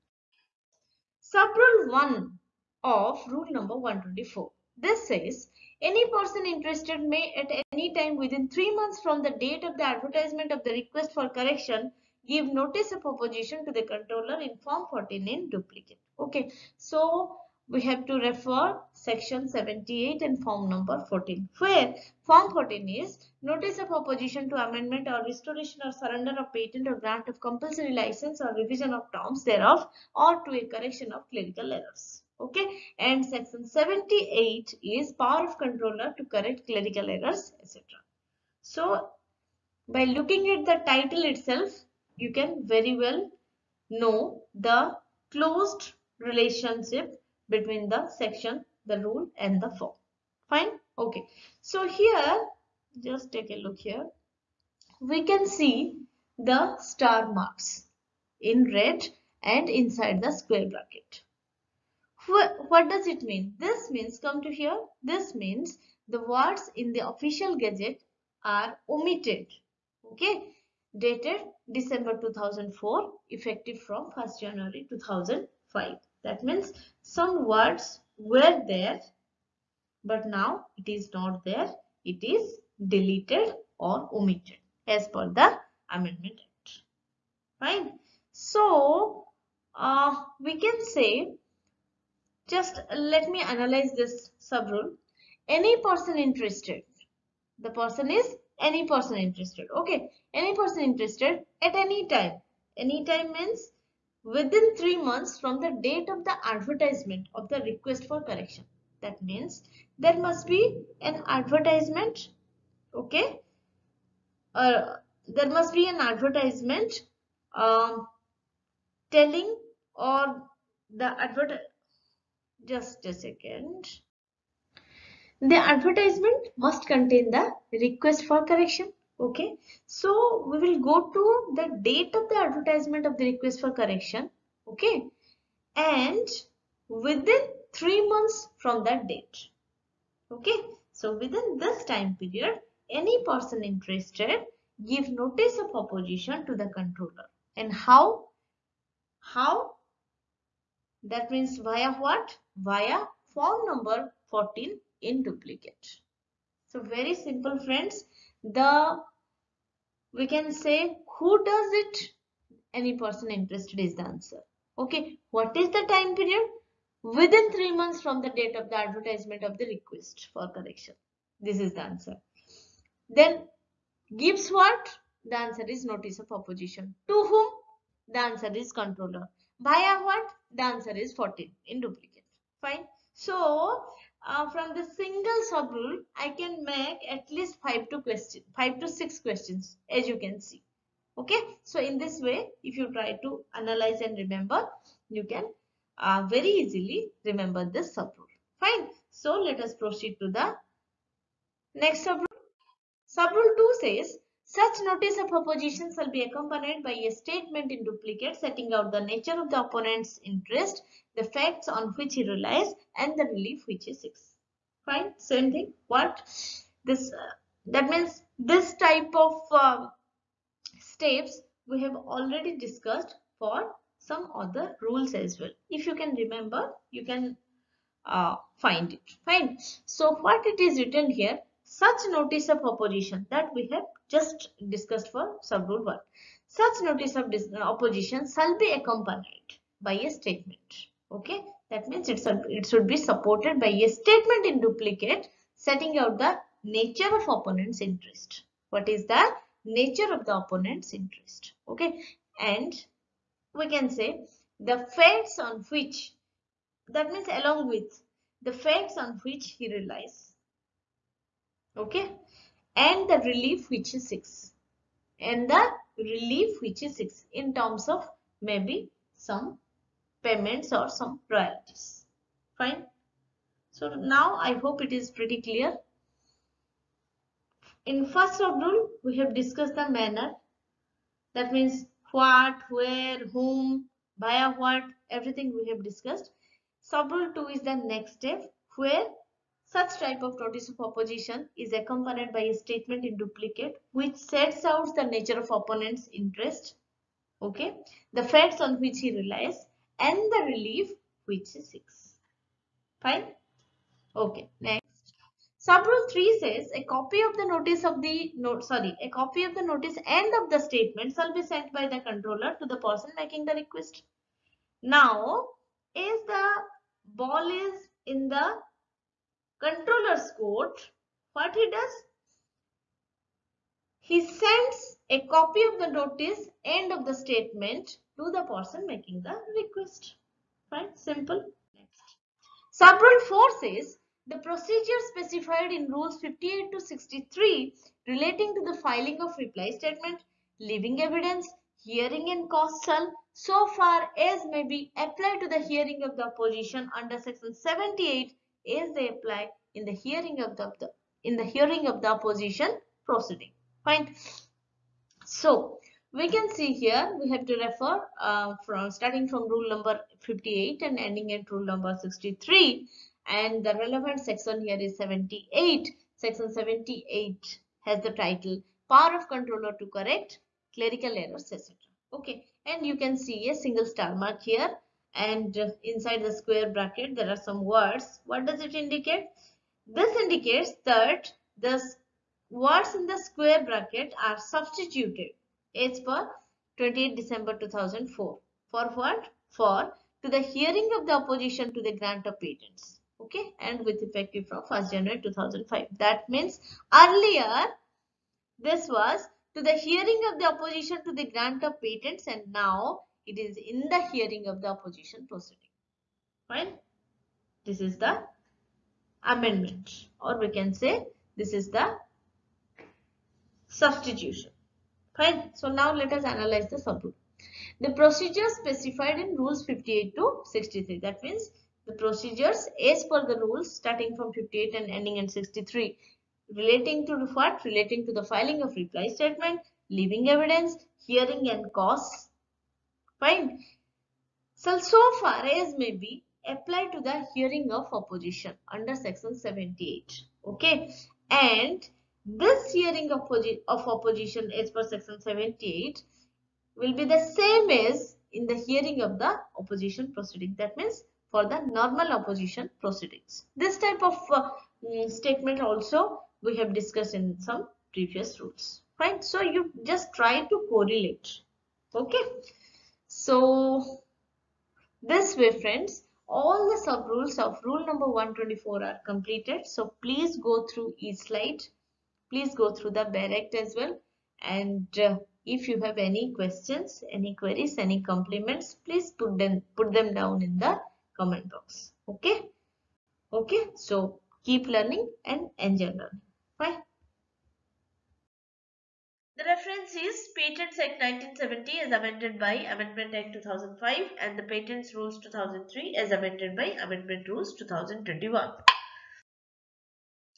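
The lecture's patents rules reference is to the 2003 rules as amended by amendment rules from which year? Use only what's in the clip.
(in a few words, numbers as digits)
2021.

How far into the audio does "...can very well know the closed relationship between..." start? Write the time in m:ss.
0:42.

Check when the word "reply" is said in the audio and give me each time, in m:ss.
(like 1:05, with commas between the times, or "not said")
5:39, 7:08.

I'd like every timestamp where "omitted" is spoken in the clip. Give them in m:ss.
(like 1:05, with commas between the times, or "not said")
1:08, 1:24.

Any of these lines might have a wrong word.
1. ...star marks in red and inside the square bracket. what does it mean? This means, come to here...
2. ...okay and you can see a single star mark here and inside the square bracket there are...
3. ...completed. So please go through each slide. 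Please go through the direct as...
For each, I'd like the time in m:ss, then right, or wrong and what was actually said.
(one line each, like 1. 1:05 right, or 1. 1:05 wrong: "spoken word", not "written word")
1. 0:56 right
2. 6:12 right
3. 7:49 right.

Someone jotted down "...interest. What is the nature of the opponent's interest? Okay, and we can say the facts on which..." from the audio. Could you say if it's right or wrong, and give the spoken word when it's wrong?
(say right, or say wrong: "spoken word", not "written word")
right.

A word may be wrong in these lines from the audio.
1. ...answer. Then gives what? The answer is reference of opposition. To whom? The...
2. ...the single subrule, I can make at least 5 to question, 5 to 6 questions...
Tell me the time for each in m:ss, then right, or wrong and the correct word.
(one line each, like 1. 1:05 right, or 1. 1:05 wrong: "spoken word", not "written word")
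1. 2:51 wrong: "notice", not "reference"
2. 3:04 right.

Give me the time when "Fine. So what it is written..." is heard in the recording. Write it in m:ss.
3:49.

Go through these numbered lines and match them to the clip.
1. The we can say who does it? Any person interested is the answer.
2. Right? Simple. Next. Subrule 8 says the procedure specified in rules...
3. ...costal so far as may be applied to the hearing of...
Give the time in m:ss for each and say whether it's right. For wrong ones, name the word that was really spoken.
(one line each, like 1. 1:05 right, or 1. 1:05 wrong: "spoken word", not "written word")
1. 2:38 right
2. 5:30 wrong: "4", not "8"
3. 5:42 right.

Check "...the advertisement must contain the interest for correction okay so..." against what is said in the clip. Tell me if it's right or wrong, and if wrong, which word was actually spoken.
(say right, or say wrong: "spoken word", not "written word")
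wrong: "request", not "interest".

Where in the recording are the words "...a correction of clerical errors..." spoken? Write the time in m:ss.
0:30.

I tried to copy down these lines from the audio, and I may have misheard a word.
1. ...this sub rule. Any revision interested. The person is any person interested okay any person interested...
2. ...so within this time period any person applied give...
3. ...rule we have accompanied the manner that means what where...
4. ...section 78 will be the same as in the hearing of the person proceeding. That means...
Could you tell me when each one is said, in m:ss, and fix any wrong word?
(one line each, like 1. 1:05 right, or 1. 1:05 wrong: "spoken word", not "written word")
1. 1:33 wrong: "person", not "revision"
2. 2:20 wrong: "interested", not "applied"
3. 4:38 wrong: "discussed", not "accompanied"
4. 7:24 wrong: "opposition", not "person".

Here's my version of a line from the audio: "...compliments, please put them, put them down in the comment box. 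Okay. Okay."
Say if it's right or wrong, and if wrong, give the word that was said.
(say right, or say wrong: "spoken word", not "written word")
right.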